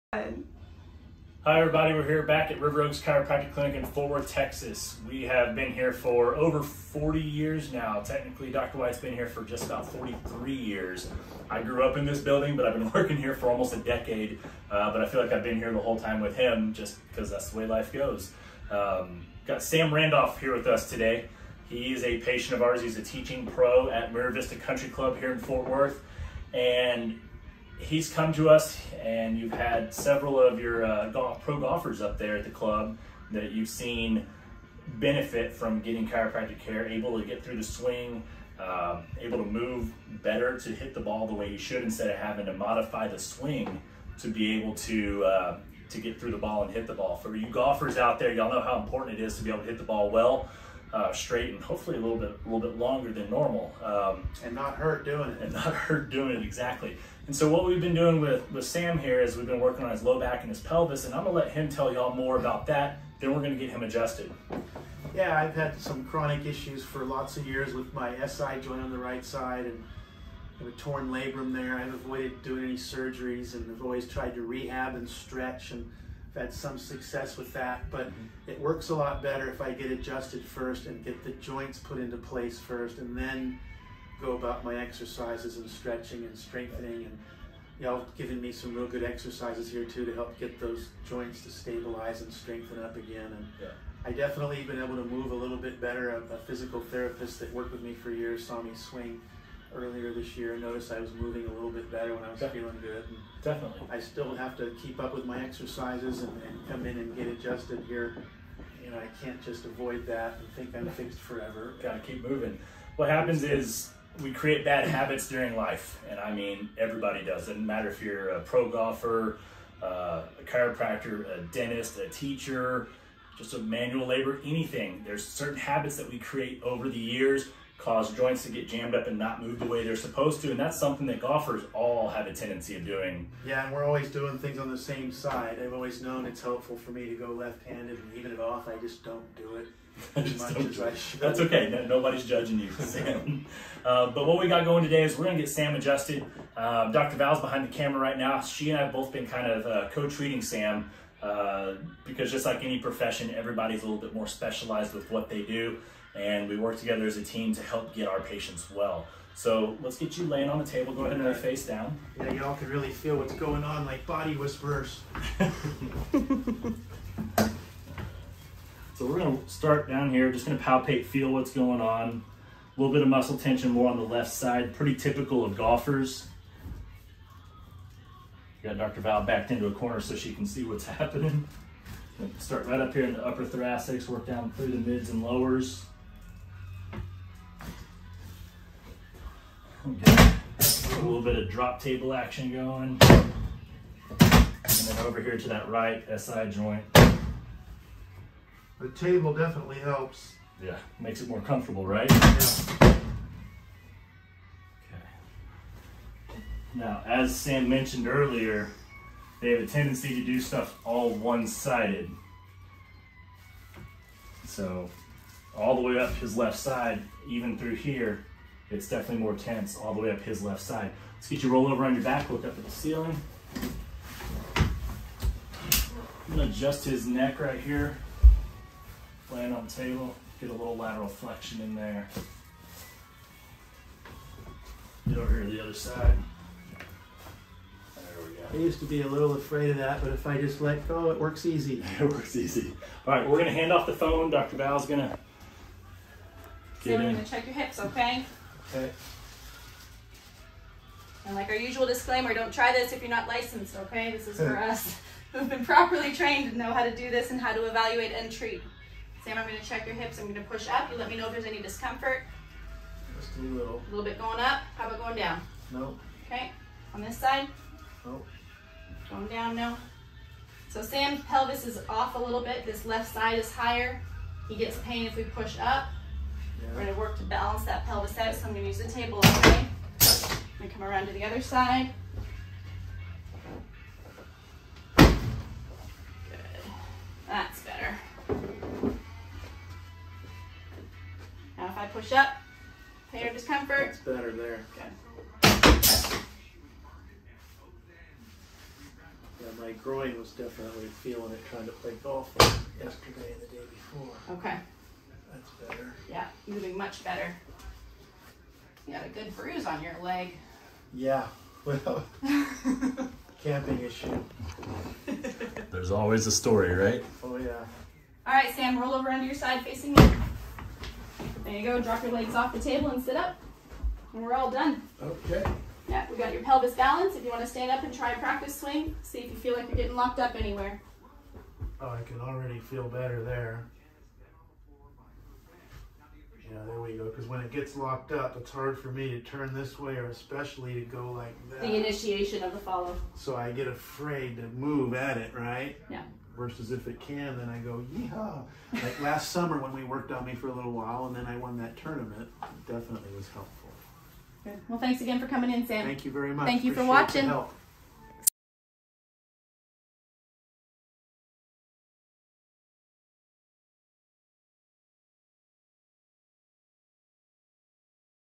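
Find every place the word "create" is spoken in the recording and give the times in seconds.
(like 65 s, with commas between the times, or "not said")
114 s, 126 s.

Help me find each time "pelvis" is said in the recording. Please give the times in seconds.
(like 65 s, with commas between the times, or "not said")
60 s, 271 s, 277 s, 326 s.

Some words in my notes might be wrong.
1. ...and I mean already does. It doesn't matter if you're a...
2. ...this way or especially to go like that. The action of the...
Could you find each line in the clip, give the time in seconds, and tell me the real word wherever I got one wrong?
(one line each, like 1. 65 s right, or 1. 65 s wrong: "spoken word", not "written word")
1. 116 s wrong: "everybody", not "already"
2. 339 s wrong: "initiation", not "action".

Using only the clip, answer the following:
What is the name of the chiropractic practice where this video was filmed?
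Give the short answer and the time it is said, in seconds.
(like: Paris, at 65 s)
River Oaks Chiropractic Clinic, at 2 s.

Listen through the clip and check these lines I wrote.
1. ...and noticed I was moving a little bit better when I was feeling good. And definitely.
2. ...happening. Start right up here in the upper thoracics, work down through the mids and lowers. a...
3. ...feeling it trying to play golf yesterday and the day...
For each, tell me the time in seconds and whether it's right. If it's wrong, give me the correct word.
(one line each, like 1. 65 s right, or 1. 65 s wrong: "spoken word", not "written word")
1. 100 s right
2. 180 s right
3. 301 s right.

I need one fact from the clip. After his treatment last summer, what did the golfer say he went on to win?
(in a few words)
Tournament.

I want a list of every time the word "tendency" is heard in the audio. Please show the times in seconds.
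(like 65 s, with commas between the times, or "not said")
132 s, 209 s.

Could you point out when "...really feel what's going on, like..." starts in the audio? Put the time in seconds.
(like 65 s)
162 s.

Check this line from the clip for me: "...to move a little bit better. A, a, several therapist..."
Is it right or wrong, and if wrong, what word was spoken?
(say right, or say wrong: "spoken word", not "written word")
wrong: "physical", not "several".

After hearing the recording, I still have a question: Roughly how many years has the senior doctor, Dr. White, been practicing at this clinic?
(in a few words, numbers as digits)
43 years.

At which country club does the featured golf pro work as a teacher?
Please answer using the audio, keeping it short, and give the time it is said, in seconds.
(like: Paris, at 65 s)
Mira Vista Country Club, at 24 s.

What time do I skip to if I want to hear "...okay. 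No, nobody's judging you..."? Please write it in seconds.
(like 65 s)
141 s.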